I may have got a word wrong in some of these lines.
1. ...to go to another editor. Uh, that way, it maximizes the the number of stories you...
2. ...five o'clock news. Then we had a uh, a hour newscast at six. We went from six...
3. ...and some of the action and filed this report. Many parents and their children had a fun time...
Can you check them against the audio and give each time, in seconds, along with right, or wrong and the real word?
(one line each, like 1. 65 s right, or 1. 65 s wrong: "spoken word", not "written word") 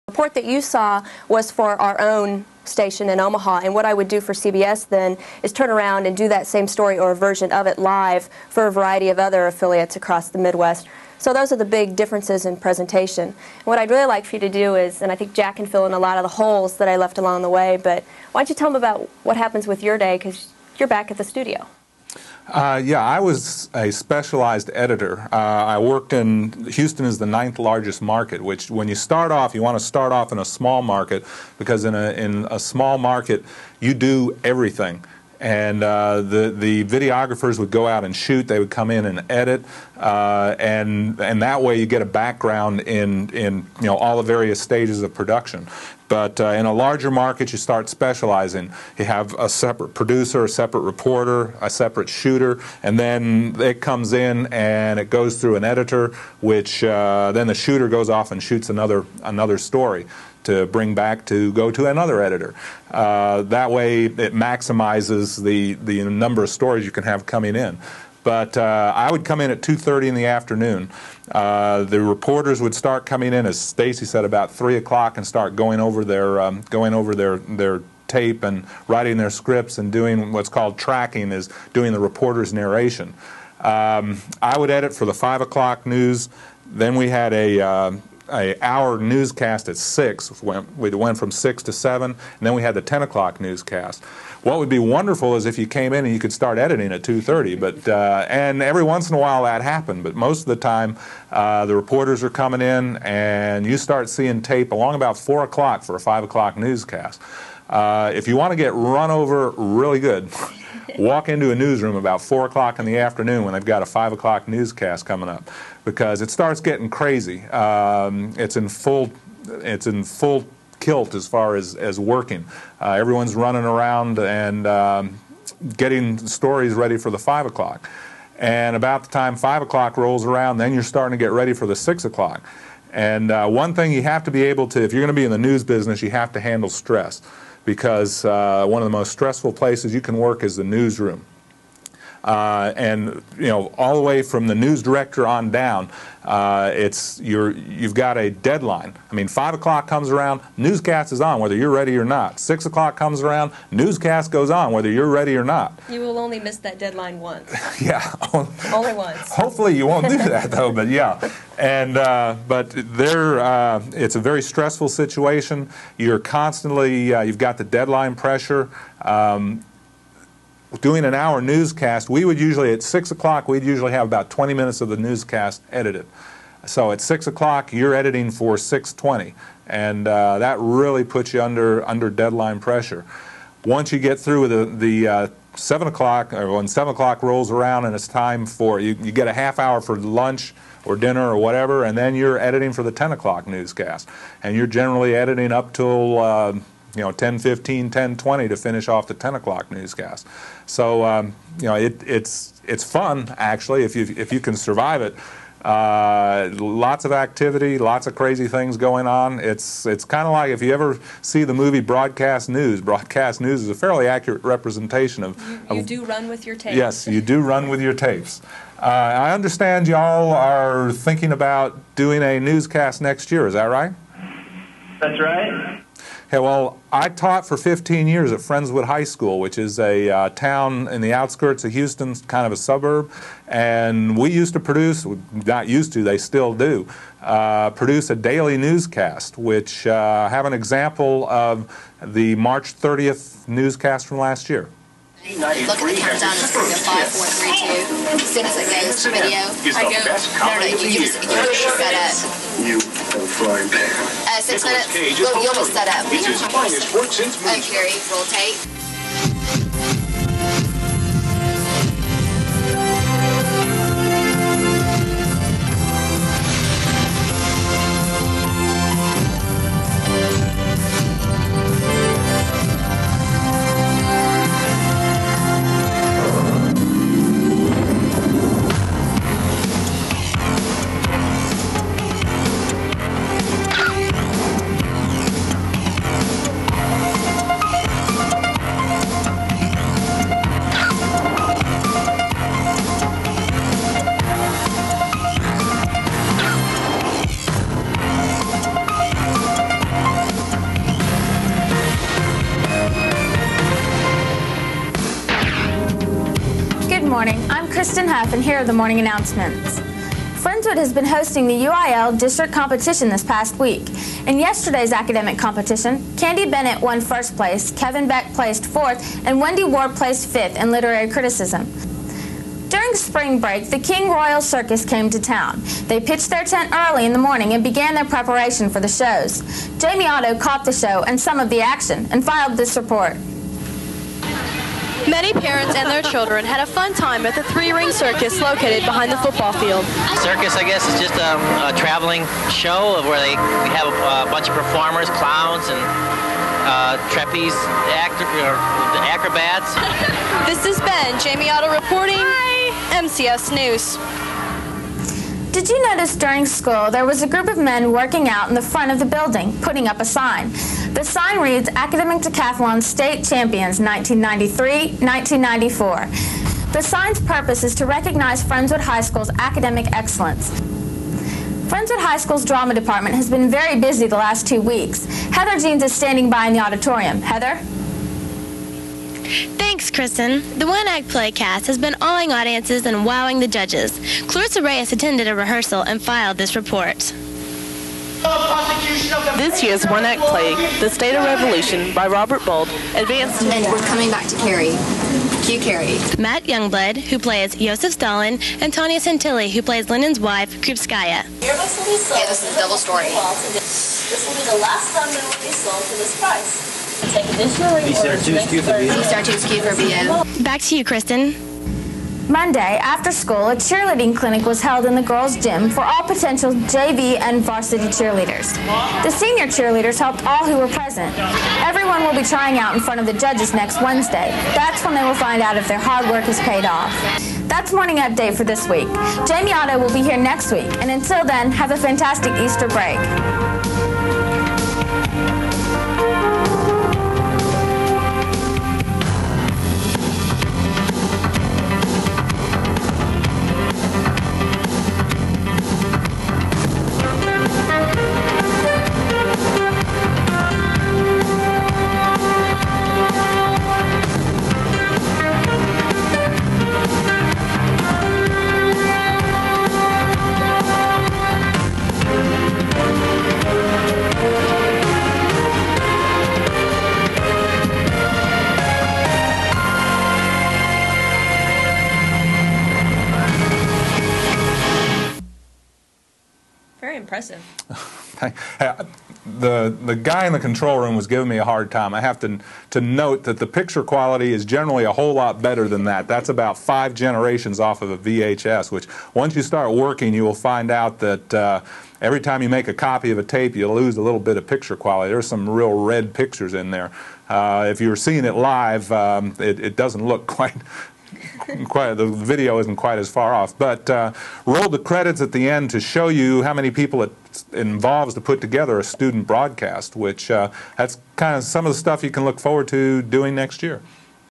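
1. 61 s right
2. 85 s right
3. 331 s right.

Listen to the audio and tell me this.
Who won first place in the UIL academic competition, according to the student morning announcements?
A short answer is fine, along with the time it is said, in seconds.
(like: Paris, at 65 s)
Candy Bennett, at 316 s.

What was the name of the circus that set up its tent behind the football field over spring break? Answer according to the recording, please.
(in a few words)
King Royal Circus.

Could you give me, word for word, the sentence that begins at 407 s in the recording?
Take additional Back to you, Kristen.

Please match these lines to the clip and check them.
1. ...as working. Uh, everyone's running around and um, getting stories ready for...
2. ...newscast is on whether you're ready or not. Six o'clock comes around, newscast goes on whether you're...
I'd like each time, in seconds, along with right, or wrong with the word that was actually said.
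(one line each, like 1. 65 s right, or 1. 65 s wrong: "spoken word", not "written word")
1. 121 s right
2. 150 s right.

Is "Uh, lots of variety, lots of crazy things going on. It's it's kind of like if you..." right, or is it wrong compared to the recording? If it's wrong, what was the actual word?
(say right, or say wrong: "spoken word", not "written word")
wrong: "activity", not "variety".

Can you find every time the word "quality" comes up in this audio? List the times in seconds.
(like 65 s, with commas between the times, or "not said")
483 s, 494 s.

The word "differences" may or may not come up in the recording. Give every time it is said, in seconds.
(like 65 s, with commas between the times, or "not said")
11 s.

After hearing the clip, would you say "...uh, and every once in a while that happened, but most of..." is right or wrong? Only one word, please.
right.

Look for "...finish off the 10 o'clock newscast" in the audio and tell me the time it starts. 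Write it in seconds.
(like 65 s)
198 s.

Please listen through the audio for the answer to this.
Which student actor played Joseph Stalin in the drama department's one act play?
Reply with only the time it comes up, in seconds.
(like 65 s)
396 s.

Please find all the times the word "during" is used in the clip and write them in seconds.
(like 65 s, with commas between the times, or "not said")
322 s, 356 s.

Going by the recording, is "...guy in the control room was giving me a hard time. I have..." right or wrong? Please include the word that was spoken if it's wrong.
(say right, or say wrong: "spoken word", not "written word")
right.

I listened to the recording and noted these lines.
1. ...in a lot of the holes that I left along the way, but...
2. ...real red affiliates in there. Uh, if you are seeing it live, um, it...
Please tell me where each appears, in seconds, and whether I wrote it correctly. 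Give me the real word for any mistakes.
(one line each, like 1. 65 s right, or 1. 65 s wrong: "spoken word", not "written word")
1. 15 s right
2. 495 s wrong: "pictures", not "affiliates".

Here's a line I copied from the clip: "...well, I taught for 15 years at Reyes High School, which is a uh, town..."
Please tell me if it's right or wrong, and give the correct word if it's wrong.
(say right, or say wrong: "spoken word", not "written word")
wrong: "Friendswood", not "Reyes".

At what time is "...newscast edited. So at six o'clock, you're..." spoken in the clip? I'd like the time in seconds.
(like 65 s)
174 s.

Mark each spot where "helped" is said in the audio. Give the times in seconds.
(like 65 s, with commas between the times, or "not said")
419 s.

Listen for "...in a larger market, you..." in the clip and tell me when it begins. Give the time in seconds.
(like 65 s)
46 s.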